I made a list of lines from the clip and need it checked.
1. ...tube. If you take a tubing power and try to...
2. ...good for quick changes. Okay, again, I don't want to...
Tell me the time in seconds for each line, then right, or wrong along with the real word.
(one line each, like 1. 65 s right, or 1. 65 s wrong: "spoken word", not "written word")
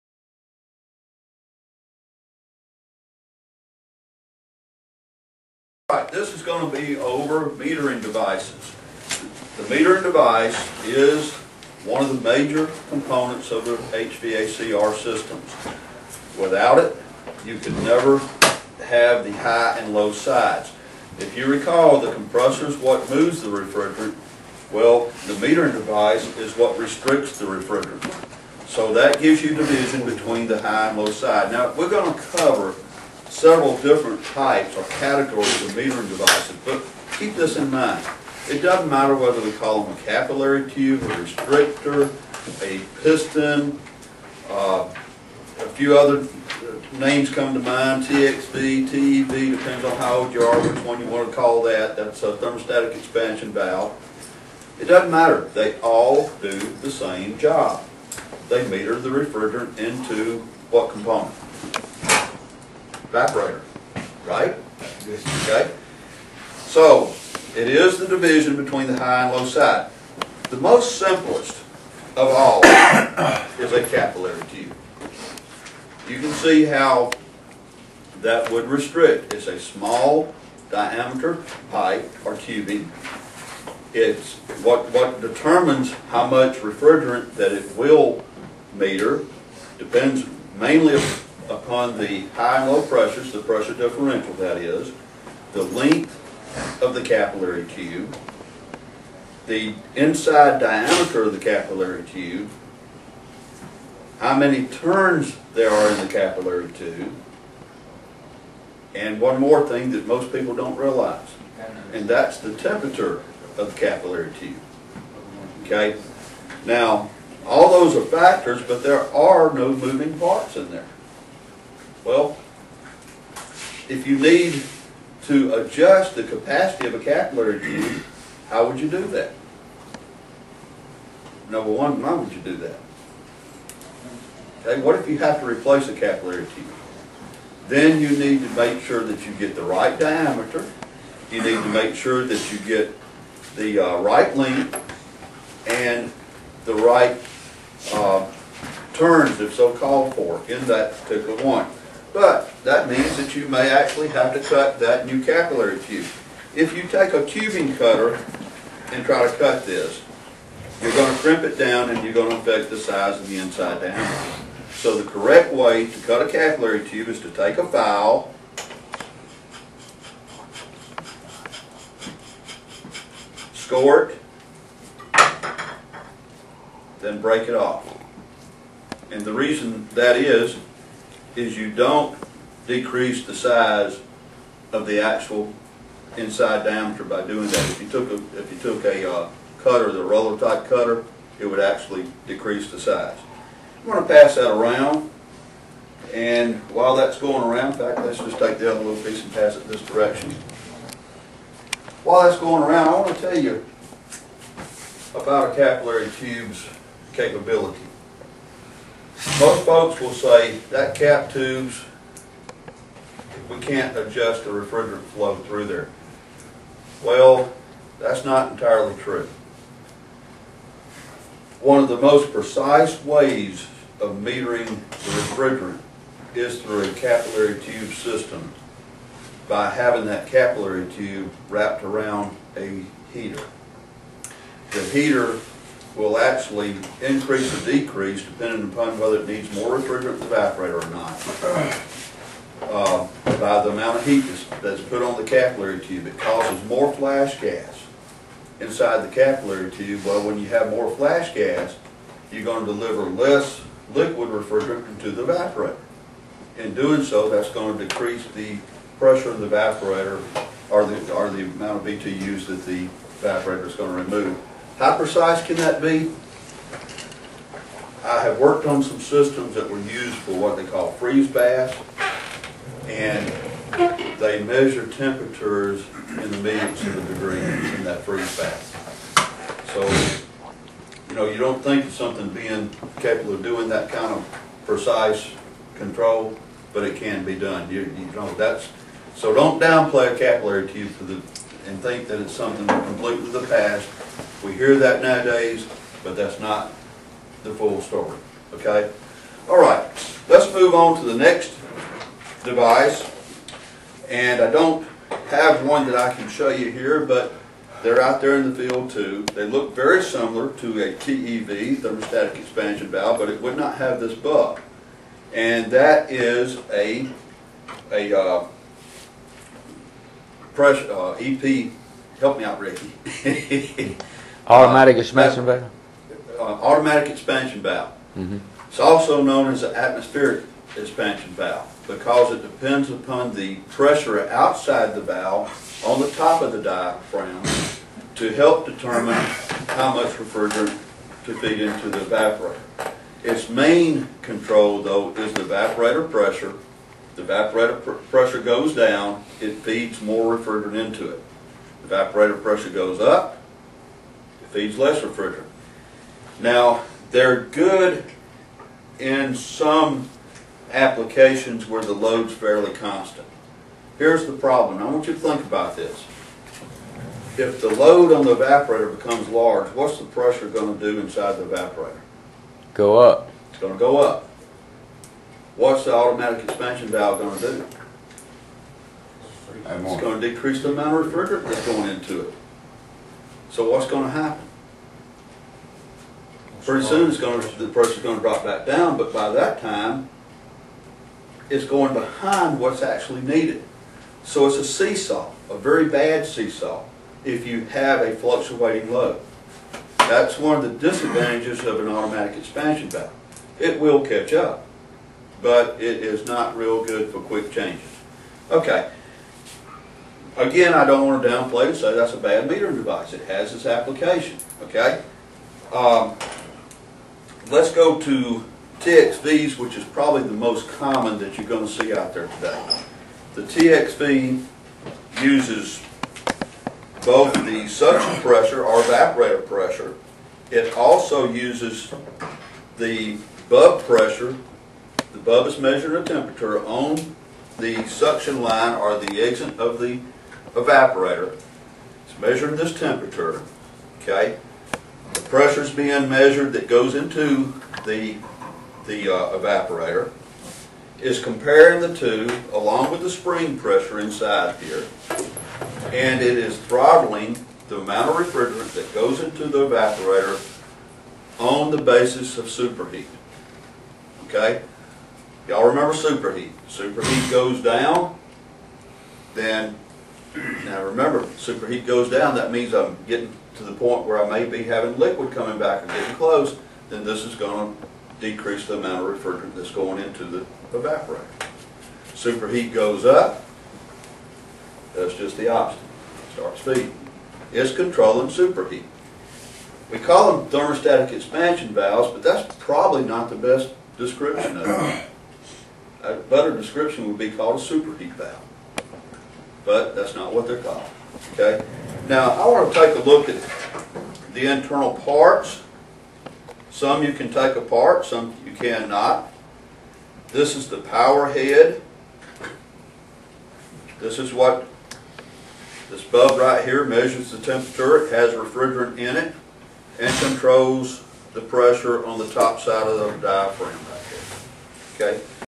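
1. 155 s wrong: "cutter", not "power"
2. 406 s right.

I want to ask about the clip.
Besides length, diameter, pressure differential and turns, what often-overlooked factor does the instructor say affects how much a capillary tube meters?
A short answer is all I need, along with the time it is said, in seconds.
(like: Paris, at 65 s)
Temperature of the capillary tube, at 112 s.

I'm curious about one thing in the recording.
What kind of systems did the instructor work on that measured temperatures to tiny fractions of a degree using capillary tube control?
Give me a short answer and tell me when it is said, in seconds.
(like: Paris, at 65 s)
Freeze baths, at 270 s.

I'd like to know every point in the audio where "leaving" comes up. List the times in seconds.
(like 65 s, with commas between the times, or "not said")
not said.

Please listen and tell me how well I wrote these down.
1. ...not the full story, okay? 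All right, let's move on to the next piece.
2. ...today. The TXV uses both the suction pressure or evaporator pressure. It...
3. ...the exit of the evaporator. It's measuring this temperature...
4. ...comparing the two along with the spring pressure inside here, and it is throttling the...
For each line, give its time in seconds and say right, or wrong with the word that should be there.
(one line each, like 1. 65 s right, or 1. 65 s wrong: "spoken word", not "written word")
1. 296 s wrong: "device", not "piece"
2. 422 s right
3. 438 s right
4. 451 s right.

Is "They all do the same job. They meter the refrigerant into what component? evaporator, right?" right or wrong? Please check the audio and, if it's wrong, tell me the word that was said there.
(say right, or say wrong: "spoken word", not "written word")
right.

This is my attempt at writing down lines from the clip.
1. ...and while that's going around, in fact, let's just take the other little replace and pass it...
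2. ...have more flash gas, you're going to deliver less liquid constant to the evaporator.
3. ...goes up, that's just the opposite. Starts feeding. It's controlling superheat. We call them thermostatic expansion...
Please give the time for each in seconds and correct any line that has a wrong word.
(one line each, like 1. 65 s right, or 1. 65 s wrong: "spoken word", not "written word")
1. 196 s wrong: "piece", not "replace"
2. 250 s wrong: "refrigerant", not "constant"
3. 482 s right.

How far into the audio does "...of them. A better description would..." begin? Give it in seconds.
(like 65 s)
494 s.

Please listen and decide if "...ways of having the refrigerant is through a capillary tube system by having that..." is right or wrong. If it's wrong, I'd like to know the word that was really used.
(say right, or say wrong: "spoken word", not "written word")
wrong: "metering", not "having".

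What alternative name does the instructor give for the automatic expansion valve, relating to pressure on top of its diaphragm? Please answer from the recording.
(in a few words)
Atmospheric expansion valve.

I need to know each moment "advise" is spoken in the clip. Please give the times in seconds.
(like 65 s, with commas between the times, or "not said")
not said.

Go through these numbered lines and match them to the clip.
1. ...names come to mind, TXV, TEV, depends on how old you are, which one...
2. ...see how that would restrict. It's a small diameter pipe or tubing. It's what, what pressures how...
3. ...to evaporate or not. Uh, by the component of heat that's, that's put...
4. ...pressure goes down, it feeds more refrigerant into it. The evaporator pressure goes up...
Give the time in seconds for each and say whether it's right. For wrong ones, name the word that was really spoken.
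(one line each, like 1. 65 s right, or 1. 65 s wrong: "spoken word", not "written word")
1. 46 s right
2. 76 s wrong: "determines", not "pressures"
3. 240 s wrong: "amount", not "component"
4. 348 s right.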